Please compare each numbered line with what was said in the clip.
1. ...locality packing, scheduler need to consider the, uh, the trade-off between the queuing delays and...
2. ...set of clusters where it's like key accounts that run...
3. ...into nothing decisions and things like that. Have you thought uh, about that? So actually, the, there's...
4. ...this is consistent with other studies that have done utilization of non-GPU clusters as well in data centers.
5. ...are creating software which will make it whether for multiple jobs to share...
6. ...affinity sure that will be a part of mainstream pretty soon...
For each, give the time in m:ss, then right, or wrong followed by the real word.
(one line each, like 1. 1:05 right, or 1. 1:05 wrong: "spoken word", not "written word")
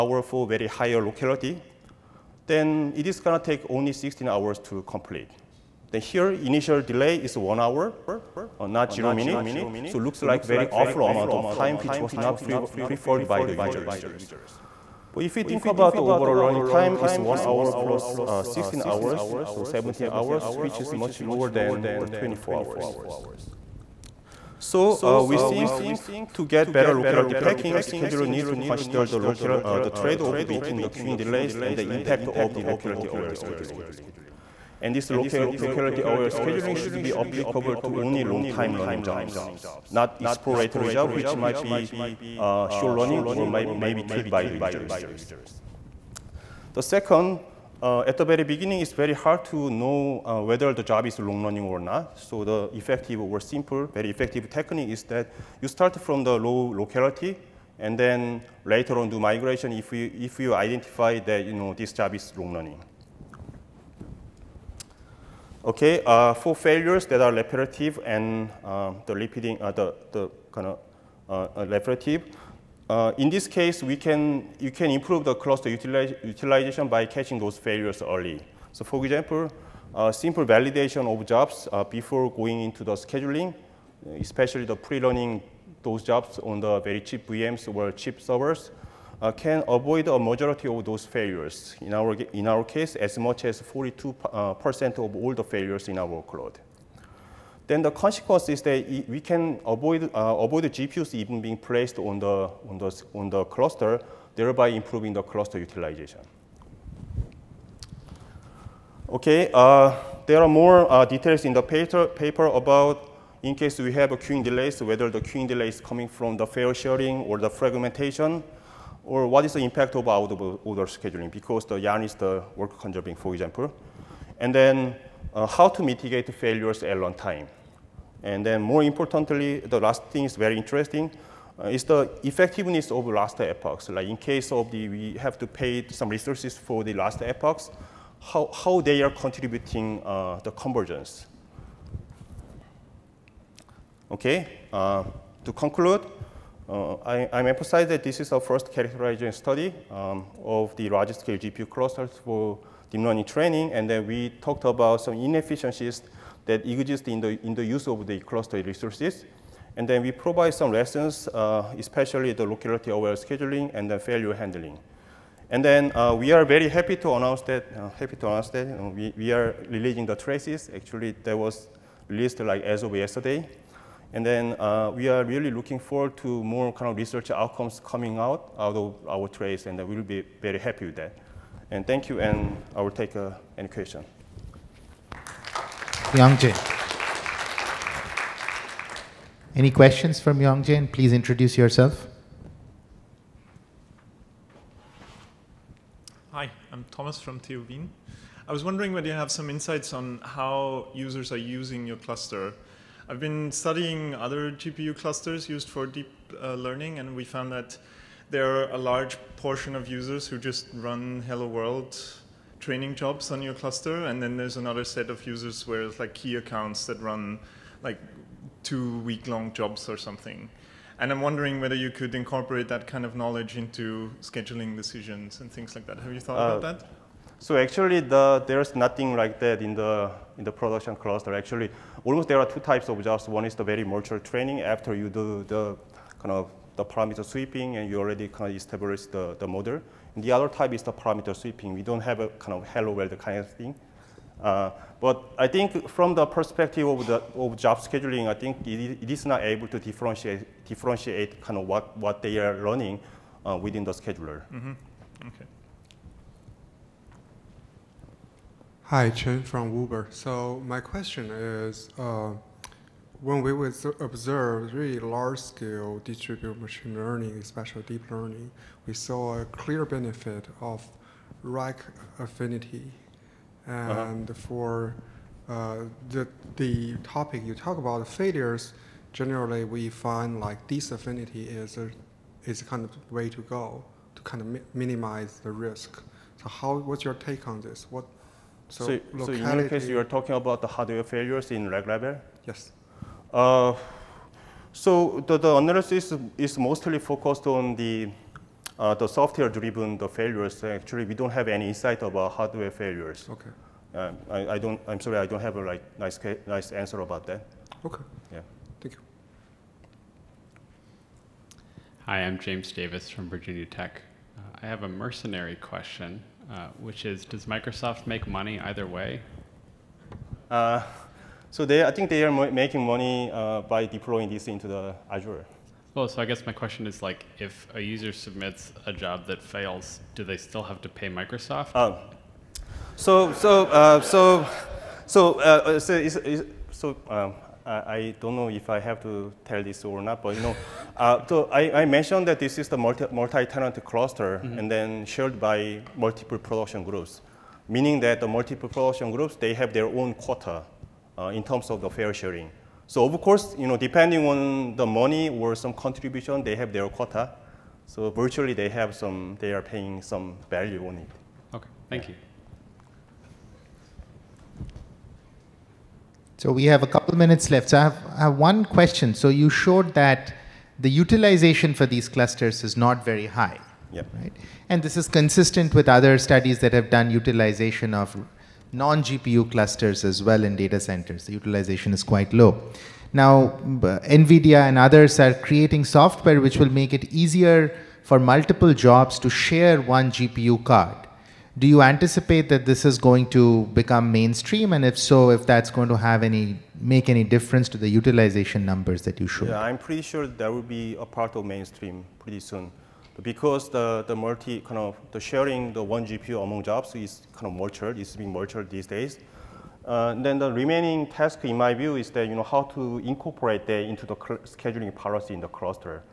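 1. 0:26 right
2. 3:34 wrong: "users", not "clusters"
3. 3:43 wrong: "scheduling", not "nothing"
4. 6:14 right
5. 6:25 wrong: "easier", not "whether"
6. 6:39 wrong: "pretty", not "affinity".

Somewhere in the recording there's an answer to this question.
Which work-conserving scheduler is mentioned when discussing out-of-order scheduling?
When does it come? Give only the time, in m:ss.
2:01.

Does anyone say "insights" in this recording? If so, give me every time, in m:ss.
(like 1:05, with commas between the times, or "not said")
3:19, 5:01.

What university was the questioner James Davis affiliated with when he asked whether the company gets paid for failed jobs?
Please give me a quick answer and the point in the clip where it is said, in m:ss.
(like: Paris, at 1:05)
Virginia Tech, at 5:13.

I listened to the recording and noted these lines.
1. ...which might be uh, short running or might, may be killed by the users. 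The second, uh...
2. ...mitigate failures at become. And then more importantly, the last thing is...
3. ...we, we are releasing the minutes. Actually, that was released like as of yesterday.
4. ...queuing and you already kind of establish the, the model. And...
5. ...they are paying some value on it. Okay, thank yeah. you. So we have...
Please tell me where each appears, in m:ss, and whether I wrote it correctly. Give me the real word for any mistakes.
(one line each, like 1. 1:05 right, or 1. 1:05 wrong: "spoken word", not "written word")
1. 0:41 right
2. 2:05 wrong: "runtime", not "become"
3. 2:48 wrong: "traces", not "minutes"
4. 3:57 wrong: "sweeping", not "queuing"
5. 5:59 right.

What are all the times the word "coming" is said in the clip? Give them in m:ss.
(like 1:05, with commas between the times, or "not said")
1:55, 2:57.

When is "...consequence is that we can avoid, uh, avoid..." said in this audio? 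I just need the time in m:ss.
1:37.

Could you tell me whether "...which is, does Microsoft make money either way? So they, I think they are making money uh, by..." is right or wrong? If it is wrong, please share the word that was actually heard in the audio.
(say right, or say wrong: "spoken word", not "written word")
right.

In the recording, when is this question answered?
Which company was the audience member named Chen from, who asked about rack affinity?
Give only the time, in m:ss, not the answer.
4:19.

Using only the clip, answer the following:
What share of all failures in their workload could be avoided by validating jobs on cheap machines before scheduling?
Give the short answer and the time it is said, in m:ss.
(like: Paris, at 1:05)
42%, at 1:33.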